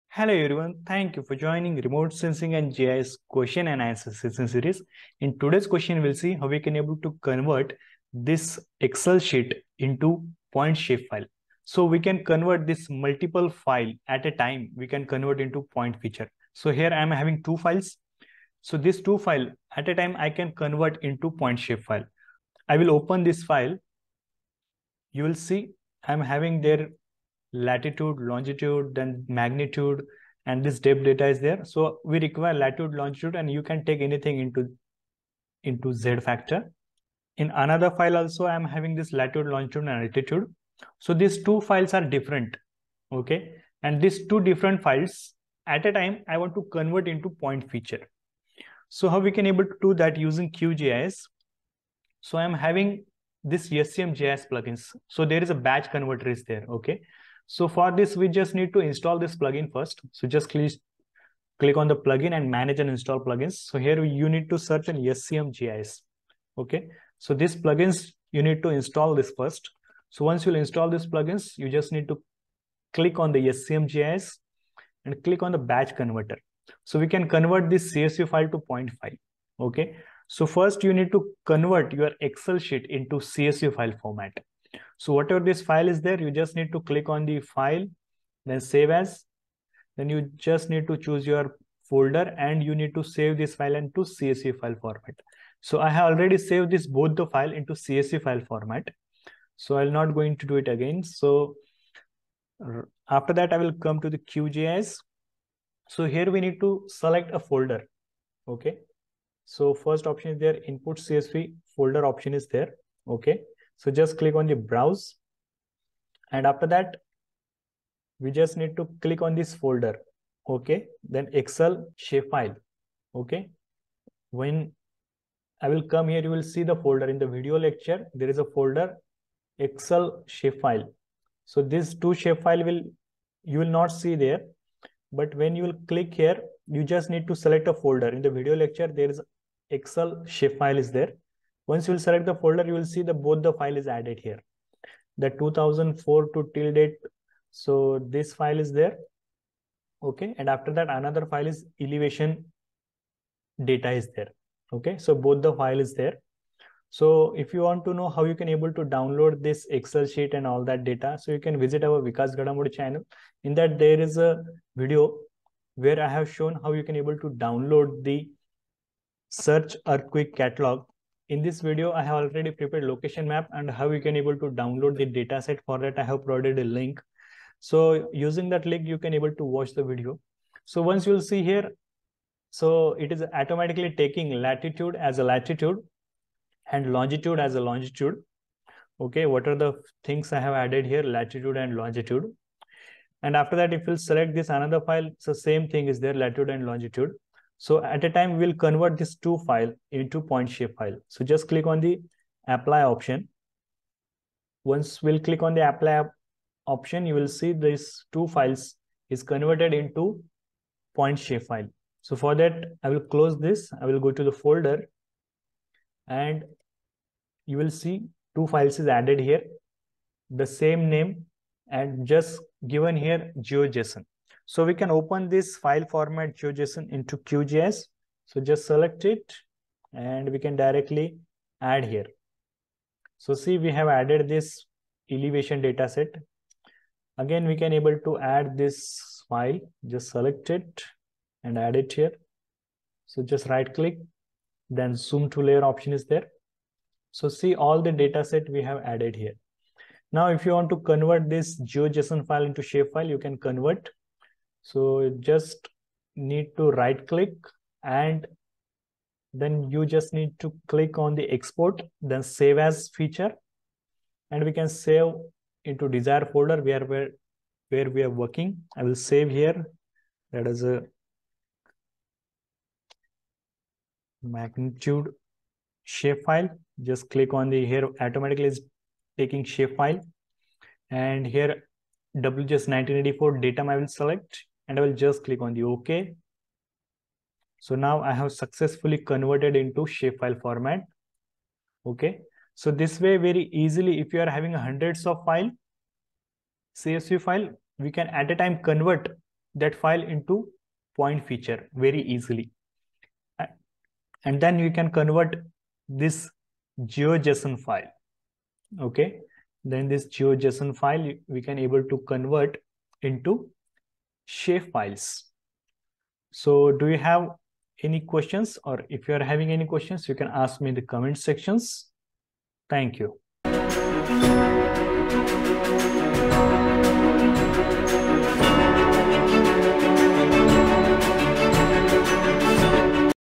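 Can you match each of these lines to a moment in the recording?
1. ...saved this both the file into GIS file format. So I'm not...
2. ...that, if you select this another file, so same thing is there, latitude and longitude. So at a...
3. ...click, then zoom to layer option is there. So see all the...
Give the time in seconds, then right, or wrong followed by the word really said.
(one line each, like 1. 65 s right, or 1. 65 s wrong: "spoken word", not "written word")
1. 96 s wrong: "CSV", not "GIS"
2. 193 s right
3. 243 s right.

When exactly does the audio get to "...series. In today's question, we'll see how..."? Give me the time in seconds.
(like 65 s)
4 s.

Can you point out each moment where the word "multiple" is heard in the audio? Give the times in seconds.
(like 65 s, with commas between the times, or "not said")
12 s.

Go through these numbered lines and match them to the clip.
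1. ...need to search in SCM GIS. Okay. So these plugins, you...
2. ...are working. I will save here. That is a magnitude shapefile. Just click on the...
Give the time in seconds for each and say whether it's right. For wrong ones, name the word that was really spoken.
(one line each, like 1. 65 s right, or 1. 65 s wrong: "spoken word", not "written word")
1. 64 s right
2. 268 s right.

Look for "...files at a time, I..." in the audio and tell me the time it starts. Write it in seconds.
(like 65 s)
44 s.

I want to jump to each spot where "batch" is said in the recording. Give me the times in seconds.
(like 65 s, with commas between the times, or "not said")
55 s, 75 s.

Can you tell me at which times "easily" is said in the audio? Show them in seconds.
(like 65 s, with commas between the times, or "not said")
293 s, 302 s.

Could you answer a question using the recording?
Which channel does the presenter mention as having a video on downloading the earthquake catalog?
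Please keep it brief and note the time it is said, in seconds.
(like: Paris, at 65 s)
Vikas Ghadamode, at 162 s.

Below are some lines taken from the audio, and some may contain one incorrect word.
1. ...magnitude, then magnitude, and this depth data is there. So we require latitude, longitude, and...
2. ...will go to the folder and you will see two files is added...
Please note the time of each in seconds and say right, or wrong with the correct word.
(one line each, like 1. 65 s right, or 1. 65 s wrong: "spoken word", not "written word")
1. 28 s wrong: "longitude", not "magnitude"
2. 213 s right.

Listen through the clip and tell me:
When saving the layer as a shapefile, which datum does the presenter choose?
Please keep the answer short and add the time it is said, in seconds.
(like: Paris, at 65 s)
WGS 1984, at 282 s.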